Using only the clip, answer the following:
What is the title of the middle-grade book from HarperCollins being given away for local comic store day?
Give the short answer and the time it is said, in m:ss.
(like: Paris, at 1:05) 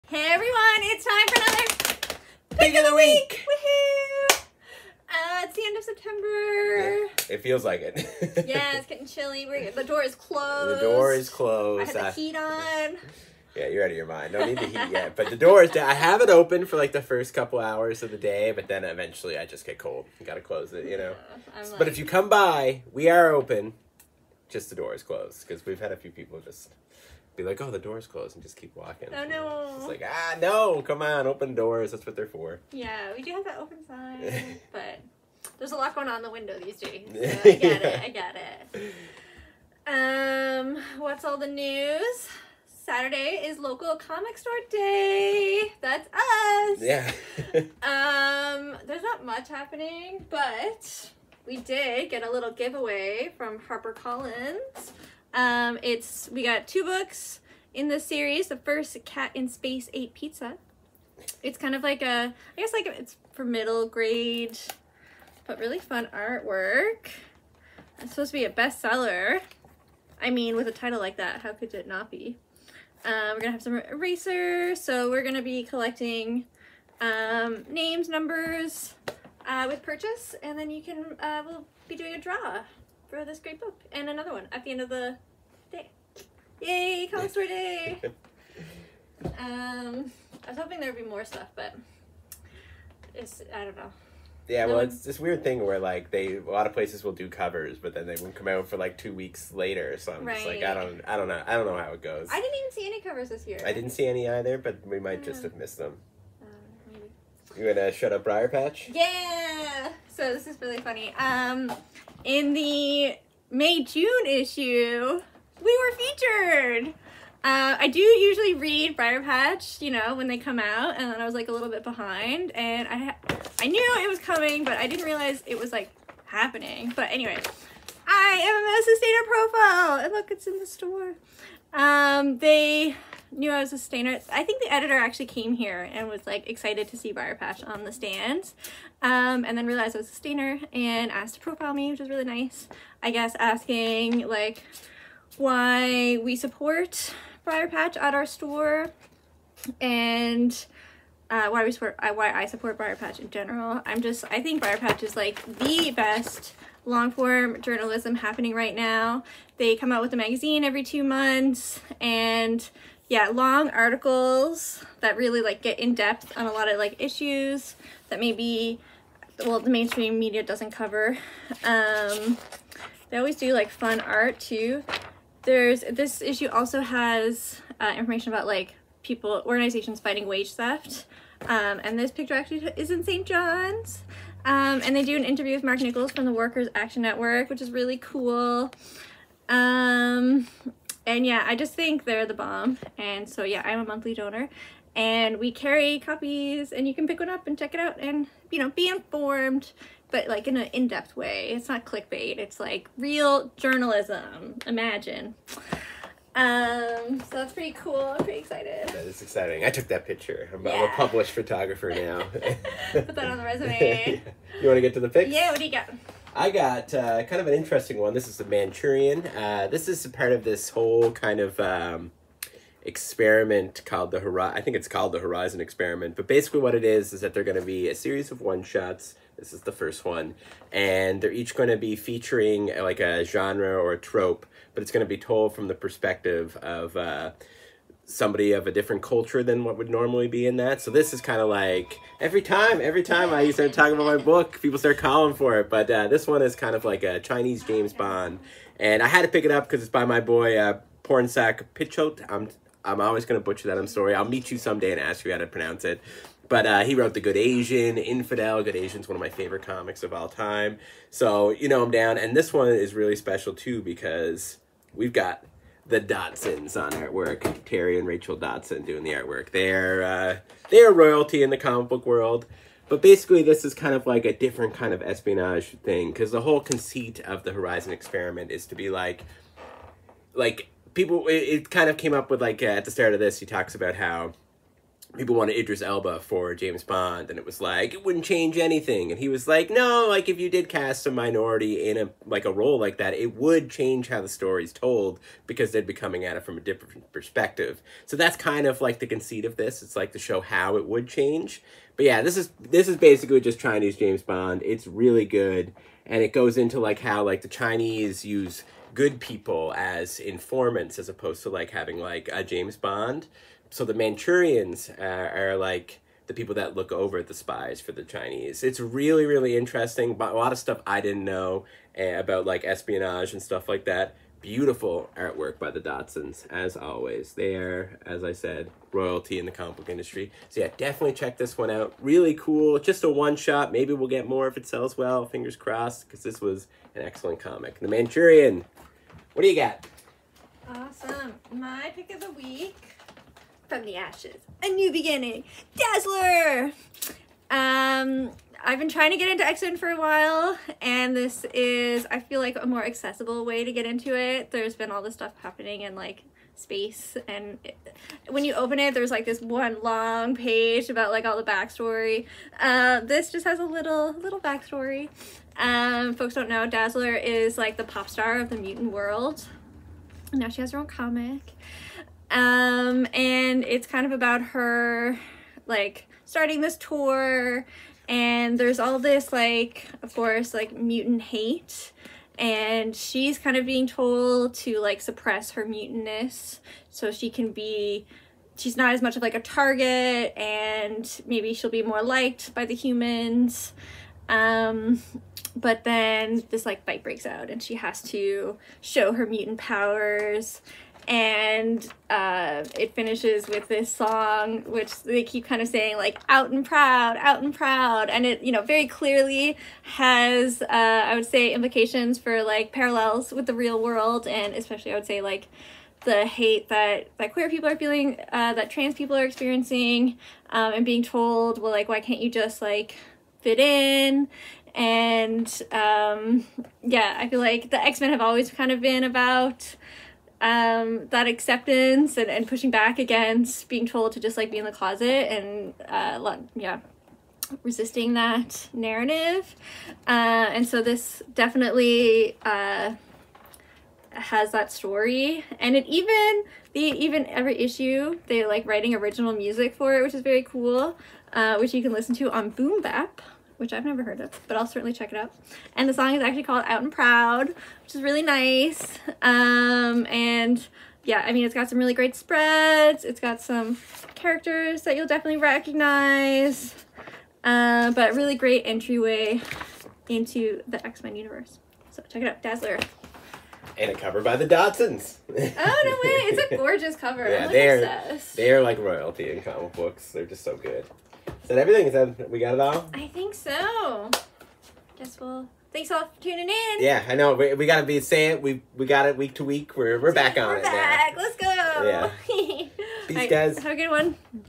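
Cat in Space Ate Pizza, at 0:59.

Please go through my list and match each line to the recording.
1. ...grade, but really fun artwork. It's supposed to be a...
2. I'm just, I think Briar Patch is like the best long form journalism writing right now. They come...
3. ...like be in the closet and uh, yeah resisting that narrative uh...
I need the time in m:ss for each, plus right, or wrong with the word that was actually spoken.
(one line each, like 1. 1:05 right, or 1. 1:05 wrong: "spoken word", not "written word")
1. 1:03 right
2. 2:33 wrong: "happening", not "writing"
3. 7:14 right.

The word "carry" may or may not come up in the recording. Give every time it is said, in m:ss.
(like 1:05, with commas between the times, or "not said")
3:15.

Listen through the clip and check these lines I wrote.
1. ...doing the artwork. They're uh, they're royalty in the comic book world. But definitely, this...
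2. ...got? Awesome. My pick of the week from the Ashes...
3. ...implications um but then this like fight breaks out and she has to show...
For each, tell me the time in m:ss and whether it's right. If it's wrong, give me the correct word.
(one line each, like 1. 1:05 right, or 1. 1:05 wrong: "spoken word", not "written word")
1. 4:28 wrong: "basically", not "definitely"
2. 5:39 right
3. 6:32 wrong: "humans", not "implications".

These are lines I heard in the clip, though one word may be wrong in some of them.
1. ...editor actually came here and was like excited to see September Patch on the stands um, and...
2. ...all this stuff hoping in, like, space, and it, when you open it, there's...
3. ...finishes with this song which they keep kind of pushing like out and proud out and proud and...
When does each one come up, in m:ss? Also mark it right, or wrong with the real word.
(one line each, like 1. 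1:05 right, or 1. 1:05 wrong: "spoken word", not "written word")
1. 2:14 wrong: "Briar", not "September"
2. 5:54 wrong: "happening", not "hoping"
3. 6:42 wrong: "saying", not "pushing".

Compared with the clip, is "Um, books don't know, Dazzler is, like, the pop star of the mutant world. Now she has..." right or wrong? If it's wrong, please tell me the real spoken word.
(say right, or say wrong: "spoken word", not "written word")
wrong: "folks", not "books".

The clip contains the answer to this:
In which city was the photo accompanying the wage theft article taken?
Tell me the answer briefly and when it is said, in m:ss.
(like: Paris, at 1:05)
St. John's, at 3:03.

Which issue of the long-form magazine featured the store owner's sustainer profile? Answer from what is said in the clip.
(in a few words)
May-June issue.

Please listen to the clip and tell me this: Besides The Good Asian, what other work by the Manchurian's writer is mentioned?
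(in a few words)
Infidel.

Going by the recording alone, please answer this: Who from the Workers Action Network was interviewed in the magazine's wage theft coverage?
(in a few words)
Mark Nichols.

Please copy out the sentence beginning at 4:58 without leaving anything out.
So that's kind of like the conceit of this.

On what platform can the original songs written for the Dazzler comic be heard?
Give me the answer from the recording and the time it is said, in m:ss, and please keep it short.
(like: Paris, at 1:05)
Boom Bap, at 7:32.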